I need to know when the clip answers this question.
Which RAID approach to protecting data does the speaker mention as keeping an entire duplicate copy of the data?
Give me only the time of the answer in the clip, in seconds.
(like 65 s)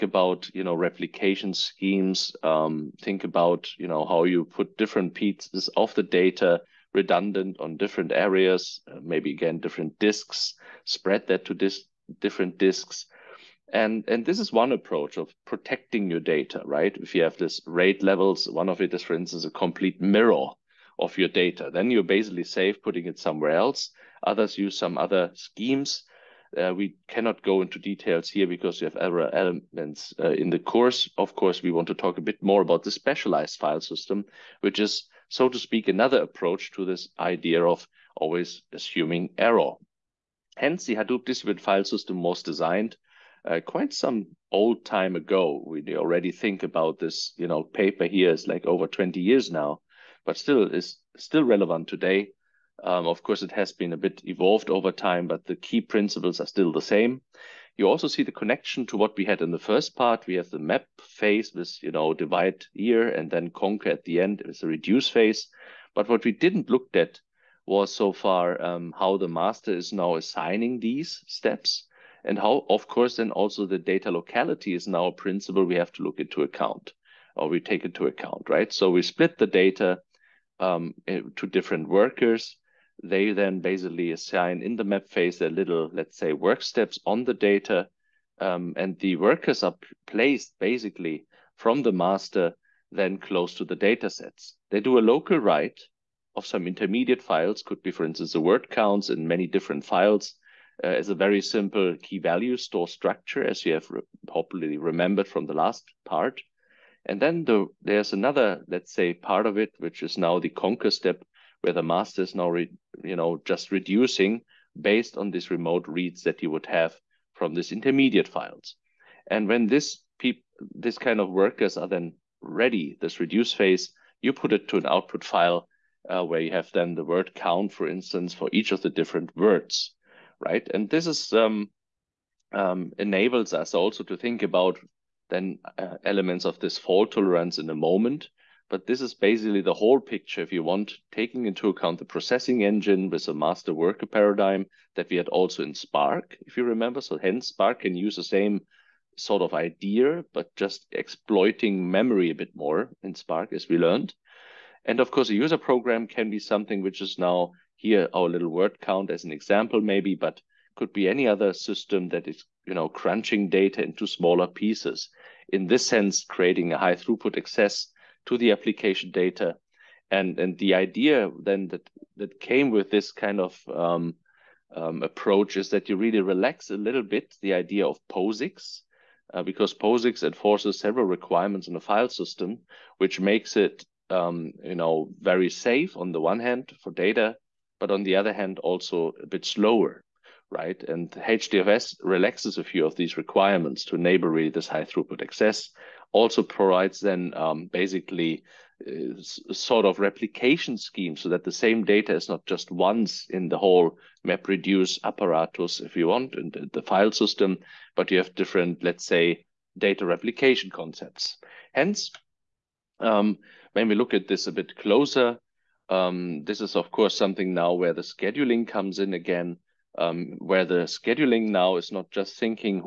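19 s.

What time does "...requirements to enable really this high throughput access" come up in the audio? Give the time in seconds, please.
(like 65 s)
193 s.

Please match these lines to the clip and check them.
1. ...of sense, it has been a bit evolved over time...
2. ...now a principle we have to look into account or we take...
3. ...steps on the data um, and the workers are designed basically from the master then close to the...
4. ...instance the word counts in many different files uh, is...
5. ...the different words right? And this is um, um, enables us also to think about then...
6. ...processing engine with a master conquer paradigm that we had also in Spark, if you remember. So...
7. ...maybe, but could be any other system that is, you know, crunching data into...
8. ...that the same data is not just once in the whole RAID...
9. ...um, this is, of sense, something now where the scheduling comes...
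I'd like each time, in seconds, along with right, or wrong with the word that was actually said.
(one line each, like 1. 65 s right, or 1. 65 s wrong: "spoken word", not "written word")
1. 53 s wrong: "course", not "sense"
2. 74 s right
3. 86 s wrong: "placed", not "designed"
4. 98 s right
5. 128 s right
6. 142 s wrong: "worker", not "conquer"
7. 159 s right
8. 201 s wrong: "MapReduce", not "RAID"
9. 215 s wrong: "course", not "sense".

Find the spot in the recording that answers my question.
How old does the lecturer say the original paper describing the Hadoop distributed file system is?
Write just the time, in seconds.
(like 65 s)
48 s.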